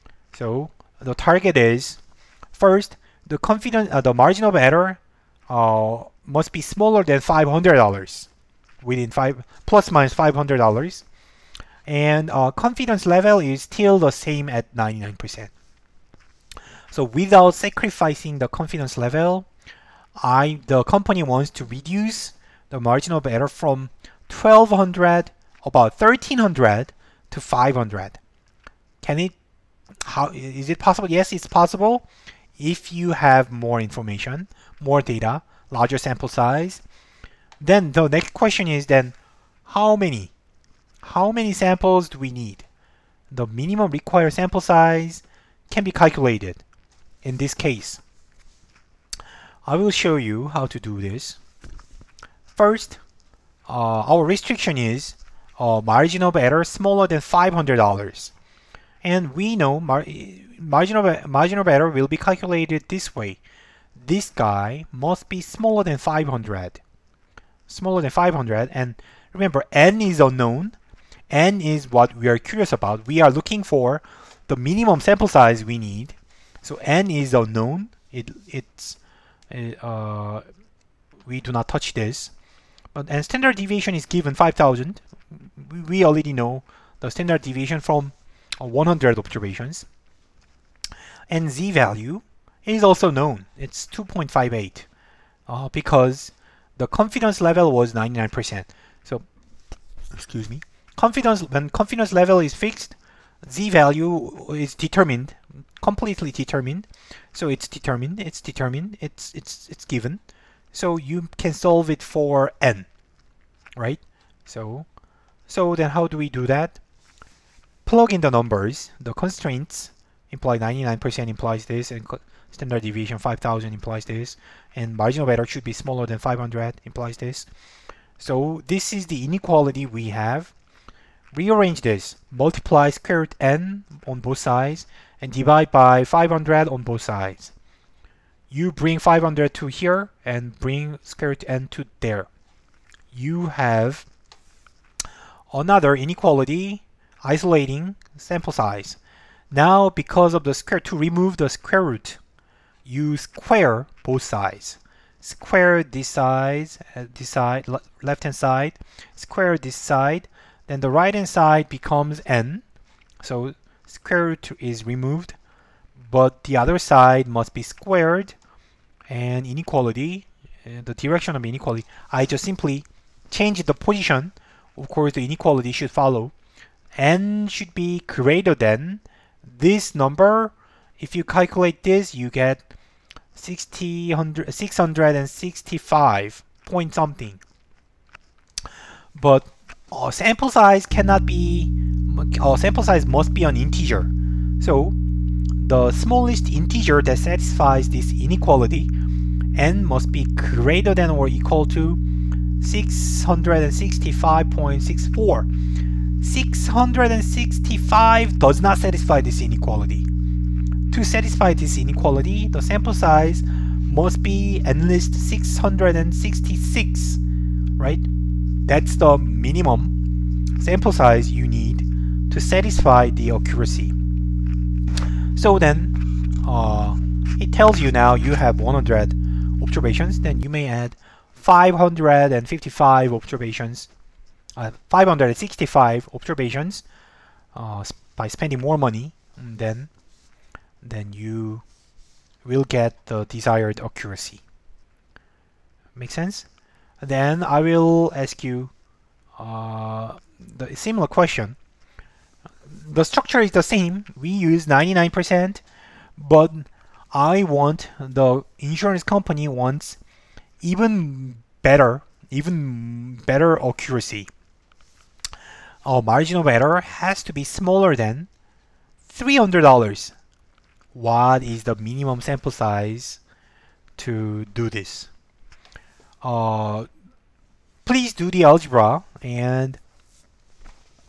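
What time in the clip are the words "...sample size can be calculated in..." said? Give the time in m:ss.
0:44.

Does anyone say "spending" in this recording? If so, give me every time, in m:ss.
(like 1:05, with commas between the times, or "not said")
3:58.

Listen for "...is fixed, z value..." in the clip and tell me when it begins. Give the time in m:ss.
1:42.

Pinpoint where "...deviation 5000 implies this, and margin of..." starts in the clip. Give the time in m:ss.
2:02.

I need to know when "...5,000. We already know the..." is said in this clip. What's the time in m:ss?
1:24.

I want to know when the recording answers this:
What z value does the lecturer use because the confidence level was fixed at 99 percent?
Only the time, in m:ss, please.
1:33.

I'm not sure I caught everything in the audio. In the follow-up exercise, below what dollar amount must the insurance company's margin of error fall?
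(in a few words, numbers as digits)
$300.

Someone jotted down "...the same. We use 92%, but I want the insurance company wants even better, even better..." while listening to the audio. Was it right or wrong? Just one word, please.
wrong.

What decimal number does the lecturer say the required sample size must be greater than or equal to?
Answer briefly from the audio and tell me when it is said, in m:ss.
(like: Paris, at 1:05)
665.64, at 3:22.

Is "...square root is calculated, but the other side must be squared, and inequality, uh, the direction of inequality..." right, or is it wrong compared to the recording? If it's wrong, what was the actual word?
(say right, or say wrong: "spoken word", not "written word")
wrong: "removed", not "calculated".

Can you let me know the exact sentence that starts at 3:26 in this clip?
665 does not satisfy this inequality.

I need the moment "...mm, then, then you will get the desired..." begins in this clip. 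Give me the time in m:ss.
3:59.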